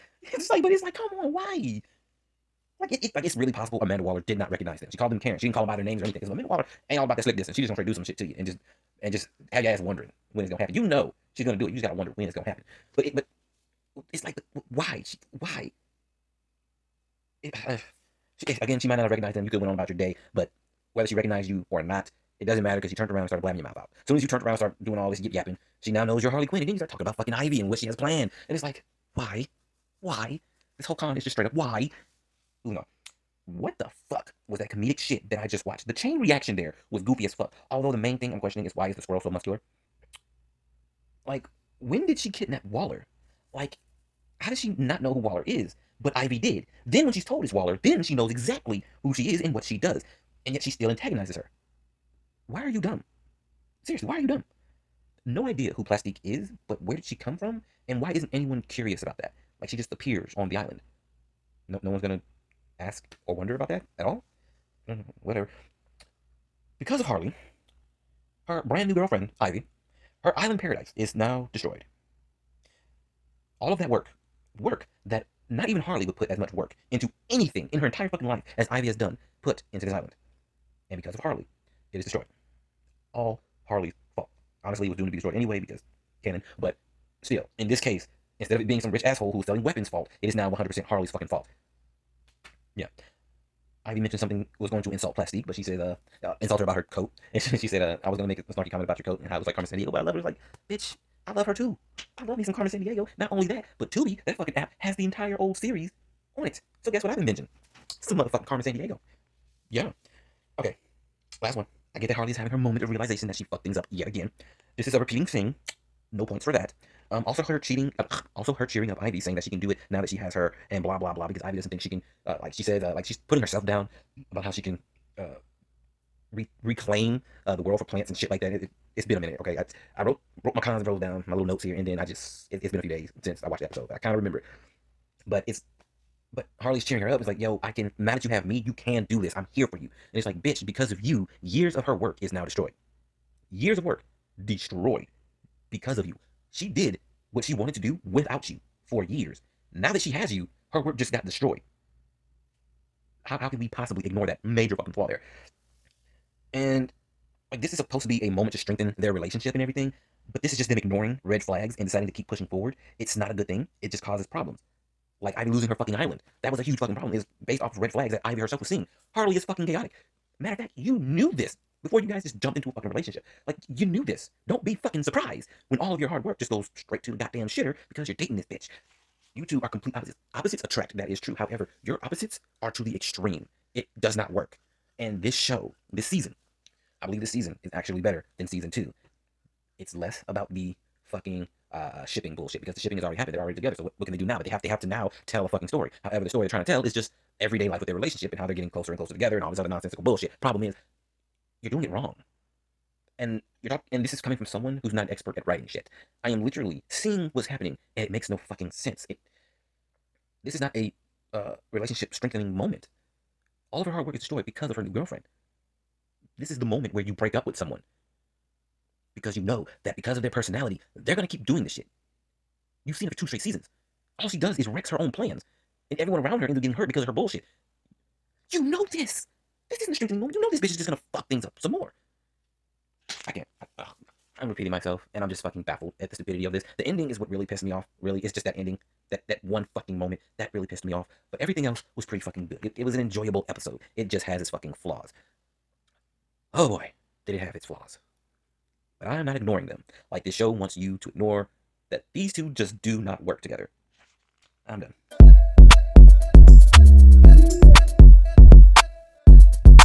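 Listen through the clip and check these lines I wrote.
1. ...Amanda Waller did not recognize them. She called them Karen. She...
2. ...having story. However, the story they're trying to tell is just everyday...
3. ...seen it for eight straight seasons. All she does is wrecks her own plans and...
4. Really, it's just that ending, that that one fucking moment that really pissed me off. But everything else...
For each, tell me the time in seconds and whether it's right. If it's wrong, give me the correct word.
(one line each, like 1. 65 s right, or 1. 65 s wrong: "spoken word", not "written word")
1. 3 s right
2. 195 s wrong: "fucking", not "having"
3. 222 s wrong: "two", not "eight"
4. 238 s right.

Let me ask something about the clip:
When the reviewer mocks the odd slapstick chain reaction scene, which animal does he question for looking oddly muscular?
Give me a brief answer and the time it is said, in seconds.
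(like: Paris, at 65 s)
squirrel, at 39 s.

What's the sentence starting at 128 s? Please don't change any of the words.
It, it it's been a minute, okay.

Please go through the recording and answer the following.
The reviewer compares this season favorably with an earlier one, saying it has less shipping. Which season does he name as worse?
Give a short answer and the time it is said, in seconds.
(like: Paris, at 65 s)
season two, at 188 s.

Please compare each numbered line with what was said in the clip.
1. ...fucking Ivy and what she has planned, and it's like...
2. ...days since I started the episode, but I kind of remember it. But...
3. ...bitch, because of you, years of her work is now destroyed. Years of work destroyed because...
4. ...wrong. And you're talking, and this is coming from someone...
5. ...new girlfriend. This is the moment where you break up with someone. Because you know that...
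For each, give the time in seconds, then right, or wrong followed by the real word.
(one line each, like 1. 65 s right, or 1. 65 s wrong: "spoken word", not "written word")
1. 27 s right
2. 132 s wrong: "watched", not "started"
3. 140 s right
4. 201 s right
5. 214 s right.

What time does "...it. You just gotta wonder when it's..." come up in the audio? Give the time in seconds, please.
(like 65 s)
11 s.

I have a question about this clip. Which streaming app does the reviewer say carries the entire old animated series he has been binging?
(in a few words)
Tubi.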